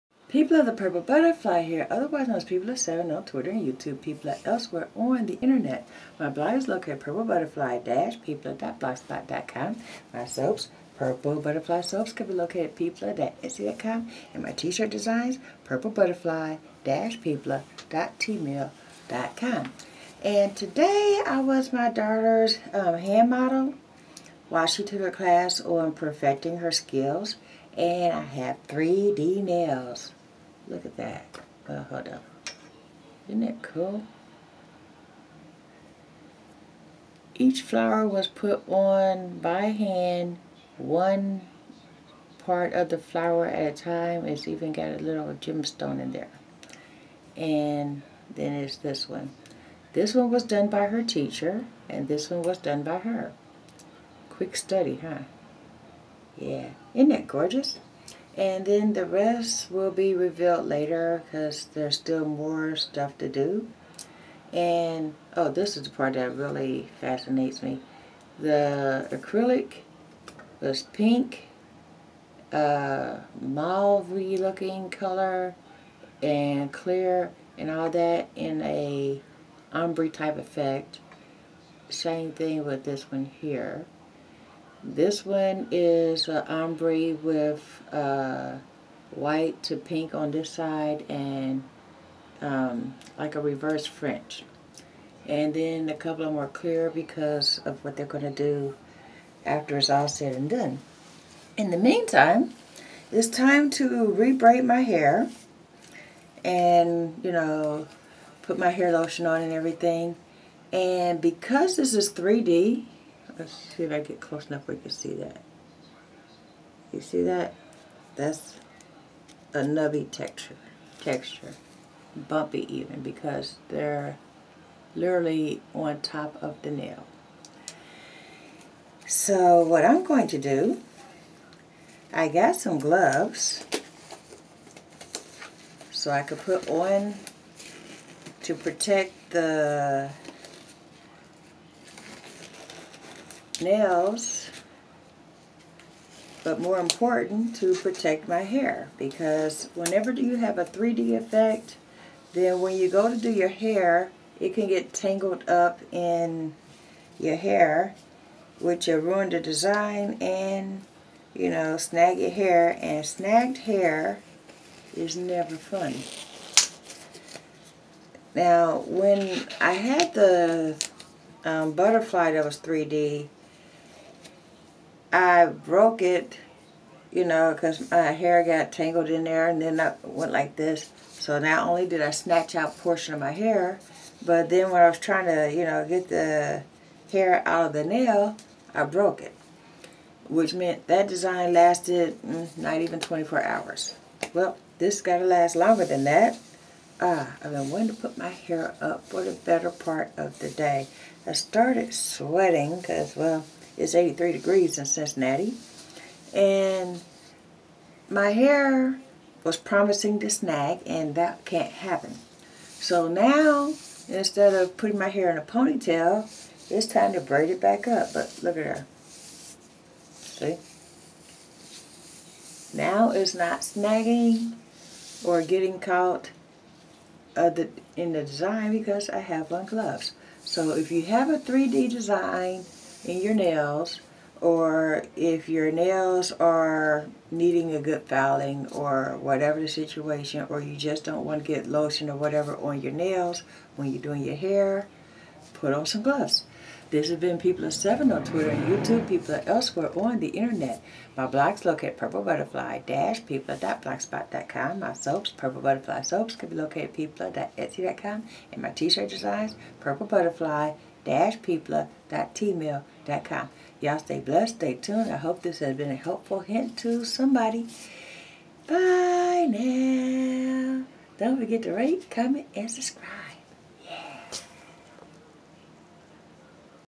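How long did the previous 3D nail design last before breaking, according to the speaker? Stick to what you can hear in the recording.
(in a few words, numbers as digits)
less than 24 hours.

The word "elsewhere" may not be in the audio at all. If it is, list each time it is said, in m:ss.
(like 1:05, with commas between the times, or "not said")
0:04, 4:09.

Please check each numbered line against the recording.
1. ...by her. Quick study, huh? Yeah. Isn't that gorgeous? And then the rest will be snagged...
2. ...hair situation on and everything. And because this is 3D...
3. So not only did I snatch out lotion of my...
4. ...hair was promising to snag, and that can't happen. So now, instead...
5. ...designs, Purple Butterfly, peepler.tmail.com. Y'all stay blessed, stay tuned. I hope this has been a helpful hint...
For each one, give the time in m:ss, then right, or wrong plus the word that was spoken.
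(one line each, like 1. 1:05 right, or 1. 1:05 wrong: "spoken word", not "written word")
1. 0:52 wrong: "revealed", not "snagged"
2. 1:48 wrong: "lotion", not "situation"
3. 3:01 wrong: "portion", not "lotion"
4. 3:28 right
5. 4:19 right.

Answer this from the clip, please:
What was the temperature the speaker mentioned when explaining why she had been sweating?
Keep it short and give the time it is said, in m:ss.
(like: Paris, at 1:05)
83 degrees, at 3:23.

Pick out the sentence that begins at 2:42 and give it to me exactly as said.
And snagged hair is never fun.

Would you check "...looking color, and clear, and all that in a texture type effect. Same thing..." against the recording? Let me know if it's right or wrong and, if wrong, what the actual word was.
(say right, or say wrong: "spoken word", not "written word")
wrong: "ombre", not "texture".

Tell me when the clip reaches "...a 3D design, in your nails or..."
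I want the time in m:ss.
3:51.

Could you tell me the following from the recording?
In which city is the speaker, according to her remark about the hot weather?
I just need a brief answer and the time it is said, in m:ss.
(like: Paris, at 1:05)
Cincinnati, at 3:24.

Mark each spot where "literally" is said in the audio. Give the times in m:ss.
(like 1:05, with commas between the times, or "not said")
2:04.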